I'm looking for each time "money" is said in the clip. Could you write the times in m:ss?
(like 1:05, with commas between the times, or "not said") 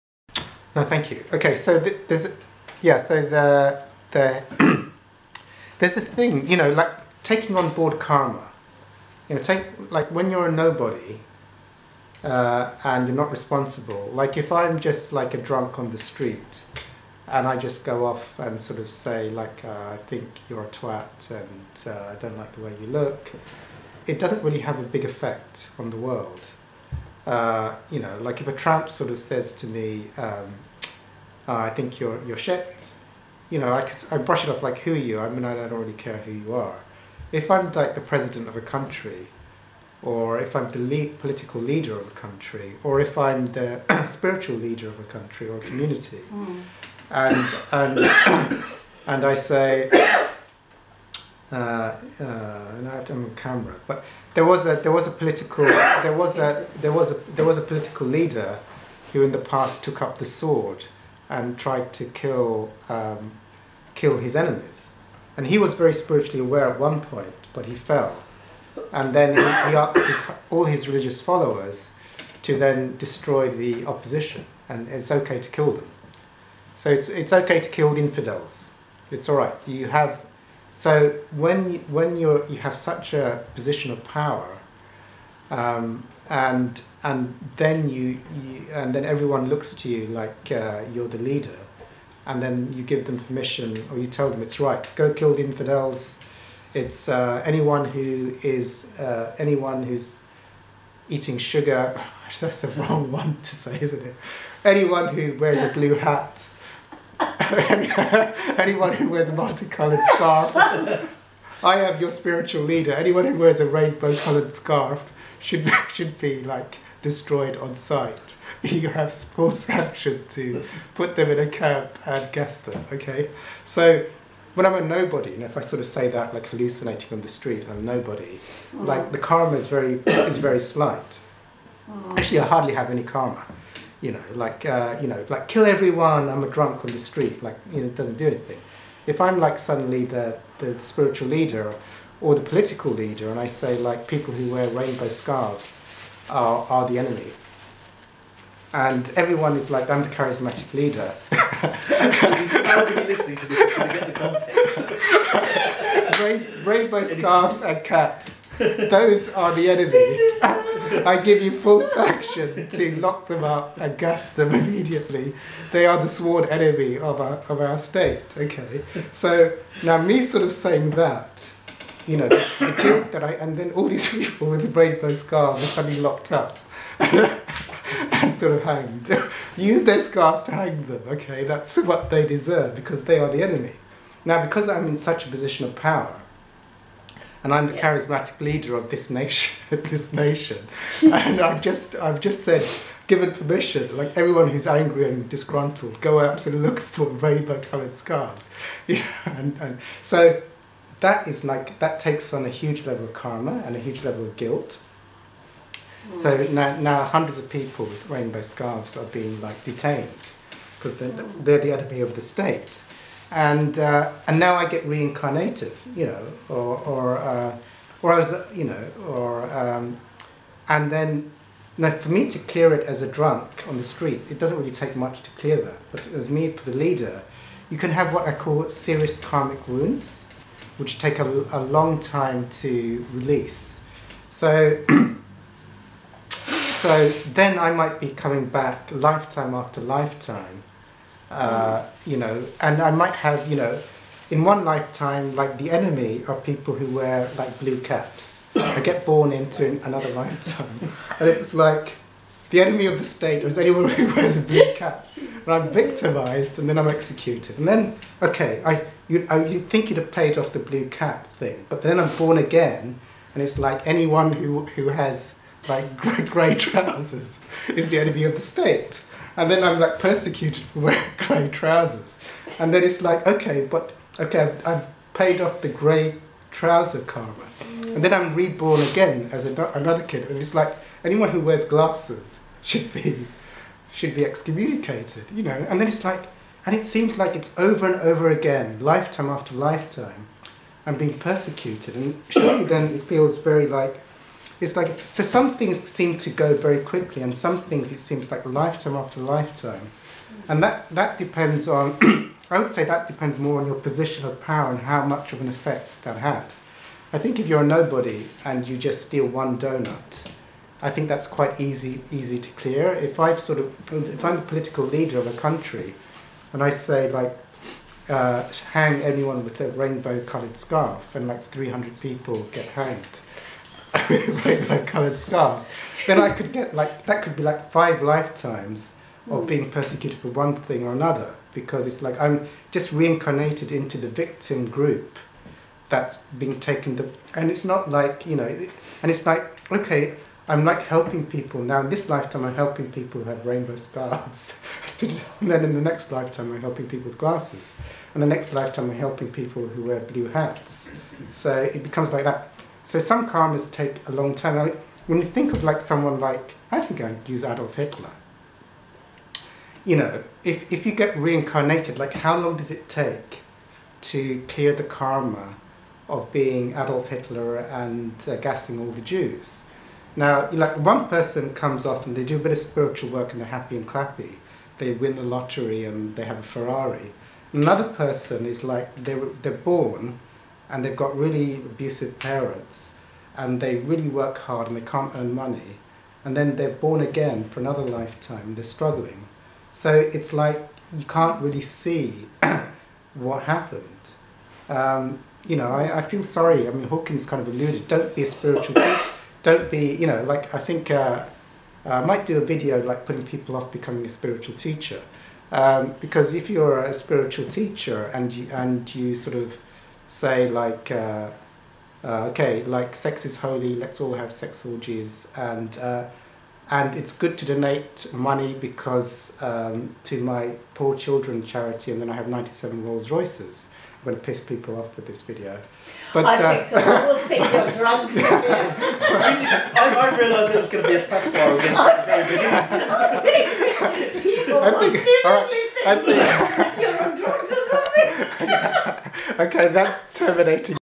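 6:25, 6:58.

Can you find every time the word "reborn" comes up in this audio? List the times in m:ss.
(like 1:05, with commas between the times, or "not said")
4:38.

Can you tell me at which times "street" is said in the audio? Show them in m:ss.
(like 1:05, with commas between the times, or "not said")
0:15, 2:07, 2:16, 3:43.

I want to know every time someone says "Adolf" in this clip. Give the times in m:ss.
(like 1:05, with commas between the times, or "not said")
5:57, 6:06.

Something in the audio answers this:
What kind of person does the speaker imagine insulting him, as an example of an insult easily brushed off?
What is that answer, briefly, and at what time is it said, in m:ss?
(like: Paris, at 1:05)
a tramp, at 0:28.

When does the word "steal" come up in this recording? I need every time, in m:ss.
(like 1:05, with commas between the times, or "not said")
5:09.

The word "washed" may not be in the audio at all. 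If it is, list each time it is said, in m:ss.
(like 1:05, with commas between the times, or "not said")
not said.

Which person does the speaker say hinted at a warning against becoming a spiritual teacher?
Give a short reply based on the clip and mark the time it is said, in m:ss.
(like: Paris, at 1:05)
Hawkins, at 6:36.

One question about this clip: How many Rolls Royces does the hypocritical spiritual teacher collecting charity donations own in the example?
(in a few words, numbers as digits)
97.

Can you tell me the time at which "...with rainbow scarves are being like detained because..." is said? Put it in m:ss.
3:27.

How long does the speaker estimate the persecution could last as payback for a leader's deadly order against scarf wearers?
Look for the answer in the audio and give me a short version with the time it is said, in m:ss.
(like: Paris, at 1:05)
5 lifetimes, at 5:27.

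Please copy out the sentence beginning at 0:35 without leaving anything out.
I mean, I don't really care who you are.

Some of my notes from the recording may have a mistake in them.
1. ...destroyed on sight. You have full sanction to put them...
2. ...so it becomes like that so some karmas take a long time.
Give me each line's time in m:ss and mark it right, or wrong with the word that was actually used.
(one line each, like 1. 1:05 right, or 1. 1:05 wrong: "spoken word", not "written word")
1. 1:57 right
2. 5:51 right.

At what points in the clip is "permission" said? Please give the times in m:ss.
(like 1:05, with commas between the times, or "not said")
1:33, 3:13.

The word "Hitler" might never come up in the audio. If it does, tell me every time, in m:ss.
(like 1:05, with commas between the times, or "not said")
5:57, 6:07.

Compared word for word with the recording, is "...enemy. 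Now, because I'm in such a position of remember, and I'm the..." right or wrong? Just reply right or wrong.
wrong.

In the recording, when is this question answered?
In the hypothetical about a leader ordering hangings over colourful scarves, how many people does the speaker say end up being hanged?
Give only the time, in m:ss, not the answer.
5:21.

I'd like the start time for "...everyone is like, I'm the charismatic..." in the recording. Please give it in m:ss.
2:29.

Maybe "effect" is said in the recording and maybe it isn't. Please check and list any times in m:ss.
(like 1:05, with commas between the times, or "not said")
0:25, 5:05.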